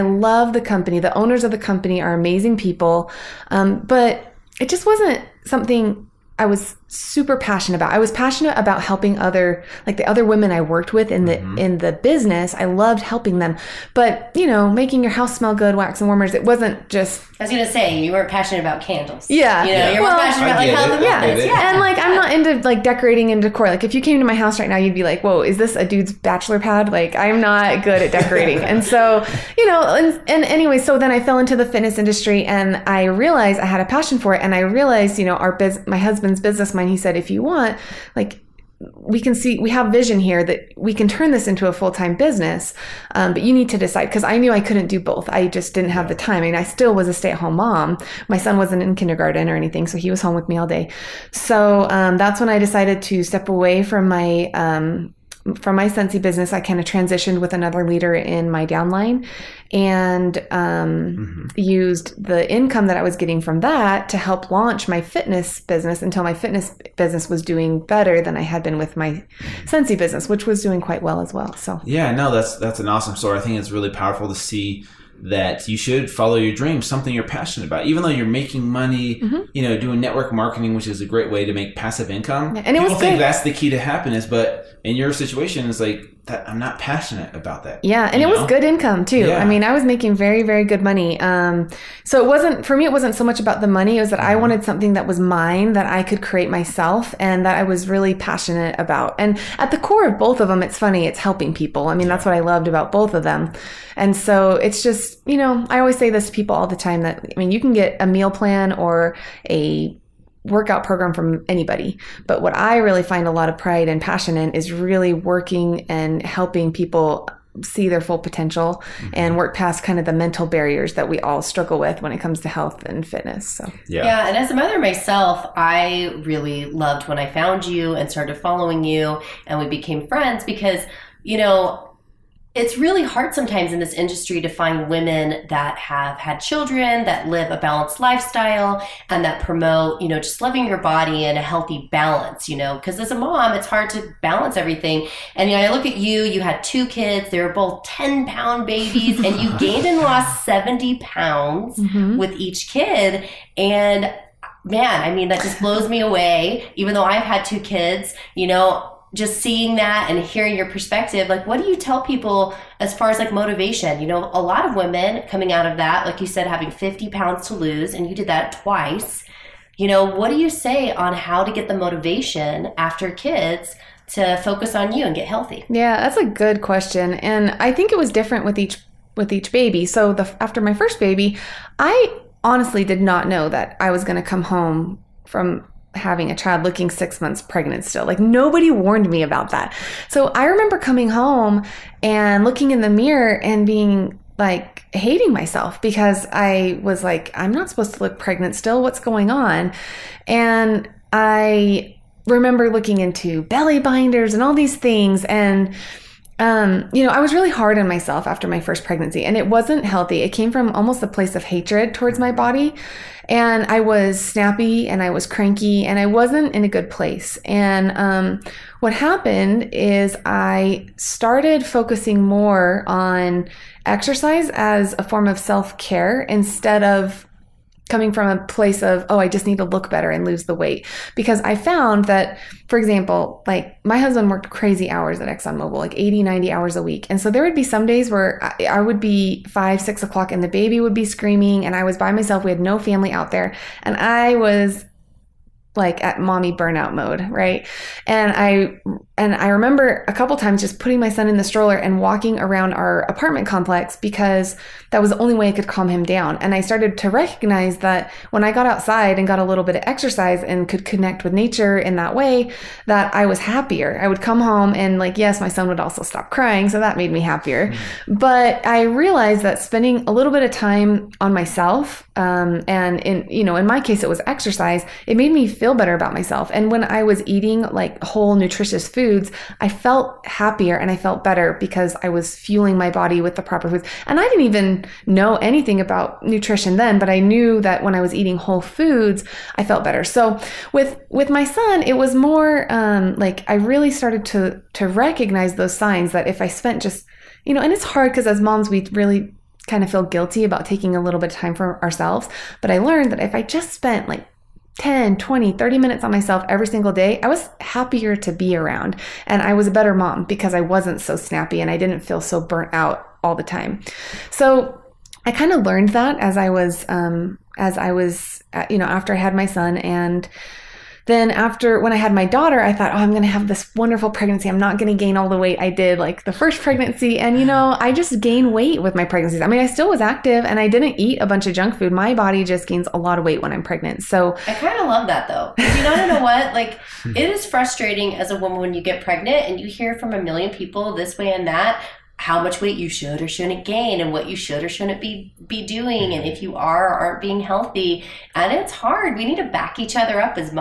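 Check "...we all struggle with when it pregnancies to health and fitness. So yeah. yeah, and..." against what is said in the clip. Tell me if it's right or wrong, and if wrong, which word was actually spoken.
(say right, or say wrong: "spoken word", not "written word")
wrong: "comes", not "pregnancies".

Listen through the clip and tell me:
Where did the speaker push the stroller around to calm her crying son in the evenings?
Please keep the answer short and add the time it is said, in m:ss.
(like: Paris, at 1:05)
apartment complex, at 4:13.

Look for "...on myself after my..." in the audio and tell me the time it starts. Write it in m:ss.
3:27.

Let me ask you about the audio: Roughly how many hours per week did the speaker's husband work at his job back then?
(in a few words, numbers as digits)
80 to 90.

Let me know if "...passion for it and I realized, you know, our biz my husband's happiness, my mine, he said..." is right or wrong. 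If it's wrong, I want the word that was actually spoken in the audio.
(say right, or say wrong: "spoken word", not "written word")
wrong: "business", not "happiness".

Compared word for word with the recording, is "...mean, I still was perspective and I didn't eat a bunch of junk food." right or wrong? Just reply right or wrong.
wrong.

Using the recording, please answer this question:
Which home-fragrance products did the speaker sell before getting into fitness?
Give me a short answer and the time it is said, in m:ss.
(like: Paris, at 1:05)
wax and warmers, at 0:15.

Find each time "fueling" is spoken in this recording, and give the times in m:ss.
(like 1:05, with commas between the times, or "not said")
4:42.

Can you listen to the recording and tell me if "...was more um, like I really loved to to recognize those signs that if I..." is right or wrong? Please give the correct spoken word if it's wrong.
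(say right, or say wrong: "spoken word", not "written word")
wrong: "started", not "loved".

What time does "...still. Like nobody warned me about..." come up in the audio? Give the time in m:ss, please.
3:07.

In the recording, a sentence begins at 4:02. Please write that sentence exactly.
We had no family out there.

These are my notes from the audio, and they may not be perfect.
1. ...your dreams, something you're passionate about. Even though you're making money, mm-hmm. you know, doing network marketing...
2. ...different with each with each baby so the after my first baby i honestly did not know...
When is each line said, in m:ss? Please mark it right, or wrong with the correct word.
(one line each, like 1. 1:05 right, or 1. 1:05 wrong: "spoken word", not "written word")
1. 1:16 right
2. 2:58 right.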